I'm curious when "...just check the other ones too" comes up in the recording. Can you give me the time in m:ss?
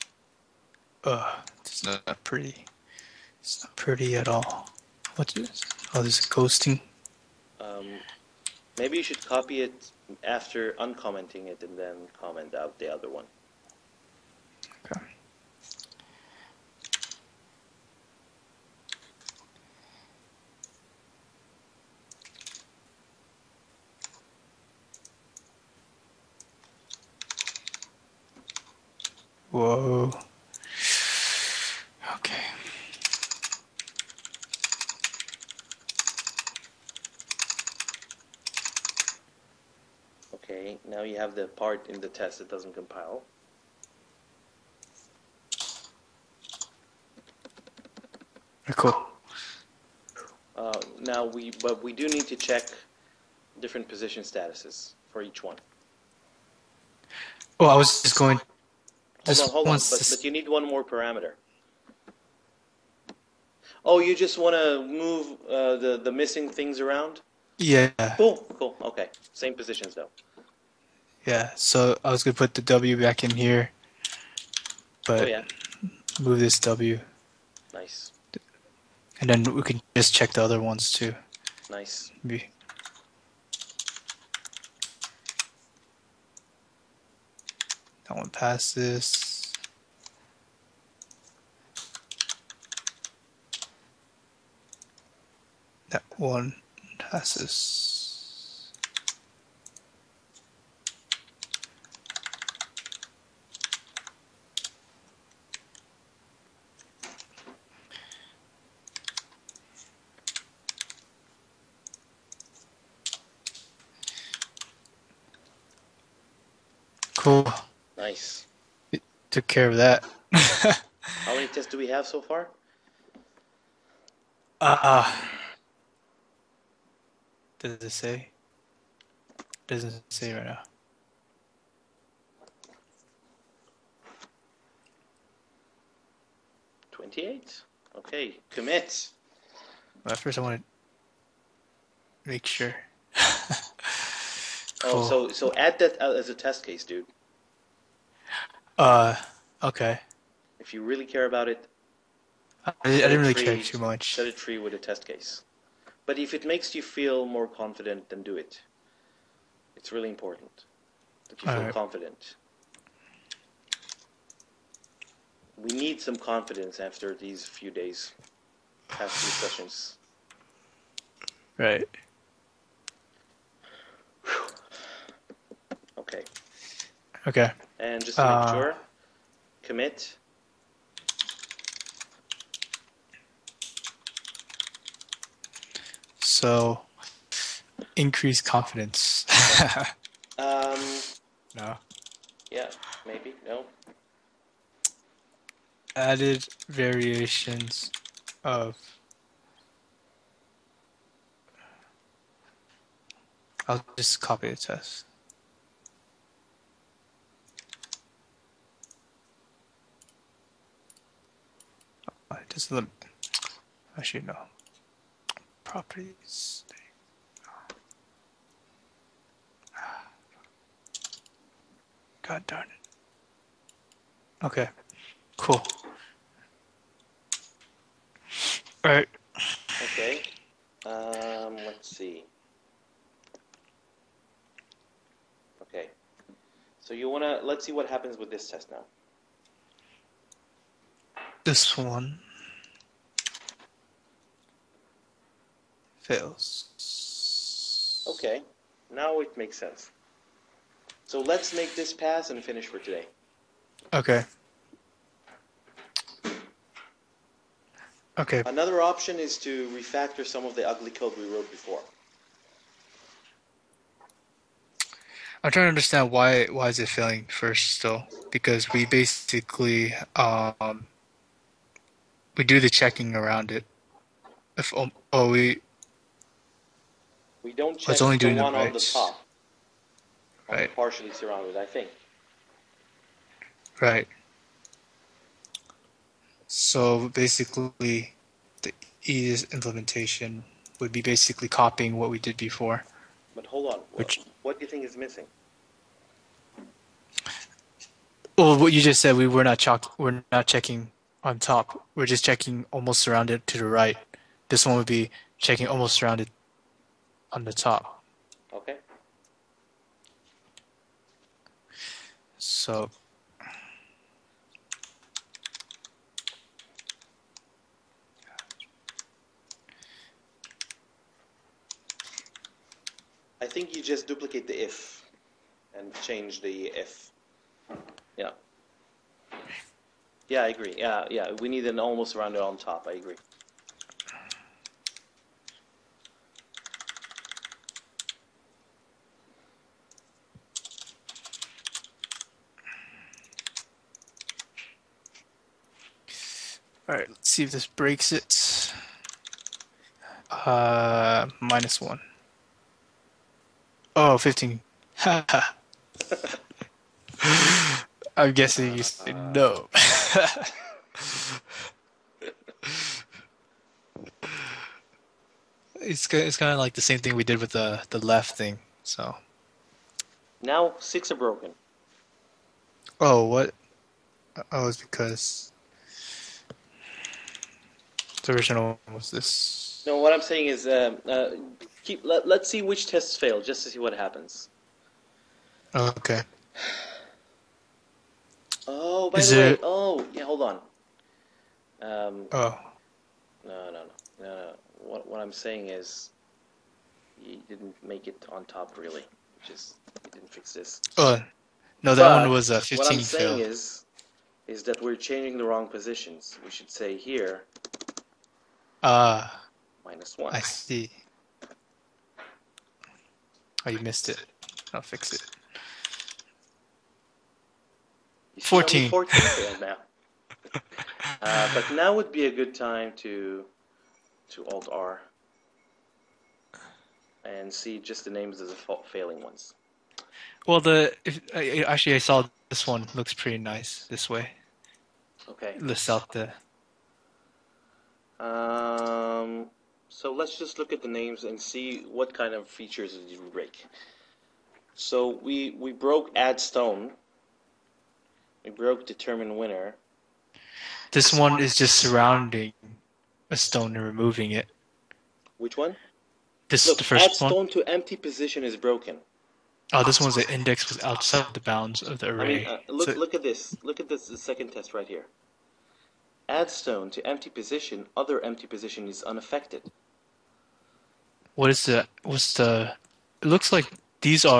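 1:19.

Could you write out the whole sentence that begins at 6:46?
We should say here, uh, minus one.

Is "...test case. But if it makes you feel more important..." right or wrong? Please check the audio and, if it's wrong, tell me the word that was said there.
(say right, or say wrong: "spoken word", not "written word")
wrong: "confident", not "important".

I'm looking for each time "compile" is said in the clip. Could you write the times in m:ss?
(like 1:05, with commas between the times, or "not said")
0:42.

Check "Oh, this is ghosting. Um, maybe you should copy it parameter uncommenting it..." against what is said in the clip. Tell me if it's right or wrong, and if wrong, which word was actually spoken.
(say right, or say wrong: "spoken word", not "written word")
wrong: "after", not "parameter".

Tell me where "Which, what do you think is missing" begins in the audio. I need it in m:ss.
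4:53.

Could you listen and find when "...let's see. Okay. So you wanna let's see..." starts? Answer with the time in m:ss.
3:51.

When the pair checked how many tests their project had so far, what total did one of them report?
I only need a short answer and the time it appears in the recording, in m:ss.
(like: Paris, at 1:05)
28, at 2:16.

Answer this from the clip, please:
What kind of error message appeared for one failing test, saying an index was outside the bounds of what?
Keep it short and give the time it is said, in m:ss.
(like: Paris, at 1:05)
the array, at 7:41.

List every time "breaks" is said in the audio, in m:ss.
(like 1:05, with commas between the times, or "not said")
5:47, 7:23.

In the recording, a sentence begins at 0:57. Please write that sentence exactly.
Well, oh, I was just going.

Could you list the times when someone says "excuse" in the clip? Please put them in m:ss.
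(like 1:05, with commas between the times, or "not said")
not said.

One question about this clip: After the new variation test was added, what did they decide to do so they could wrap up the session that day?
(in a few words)
make this pass.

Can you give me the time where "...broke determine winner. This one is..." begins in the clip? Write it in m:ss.
7:28.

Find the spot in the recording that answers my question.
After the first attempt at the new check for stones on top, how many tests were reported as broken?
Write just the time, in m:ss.
6:10.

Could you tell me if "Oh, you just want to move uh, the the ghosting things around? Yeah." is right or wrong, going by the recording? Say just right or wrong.
wrong.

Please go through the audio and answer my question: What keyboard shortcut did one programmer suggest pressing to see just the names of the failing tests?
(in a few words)
Alt R.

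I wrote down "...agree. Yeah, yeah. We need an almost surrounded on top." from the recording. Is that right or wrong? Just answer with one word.
wrong.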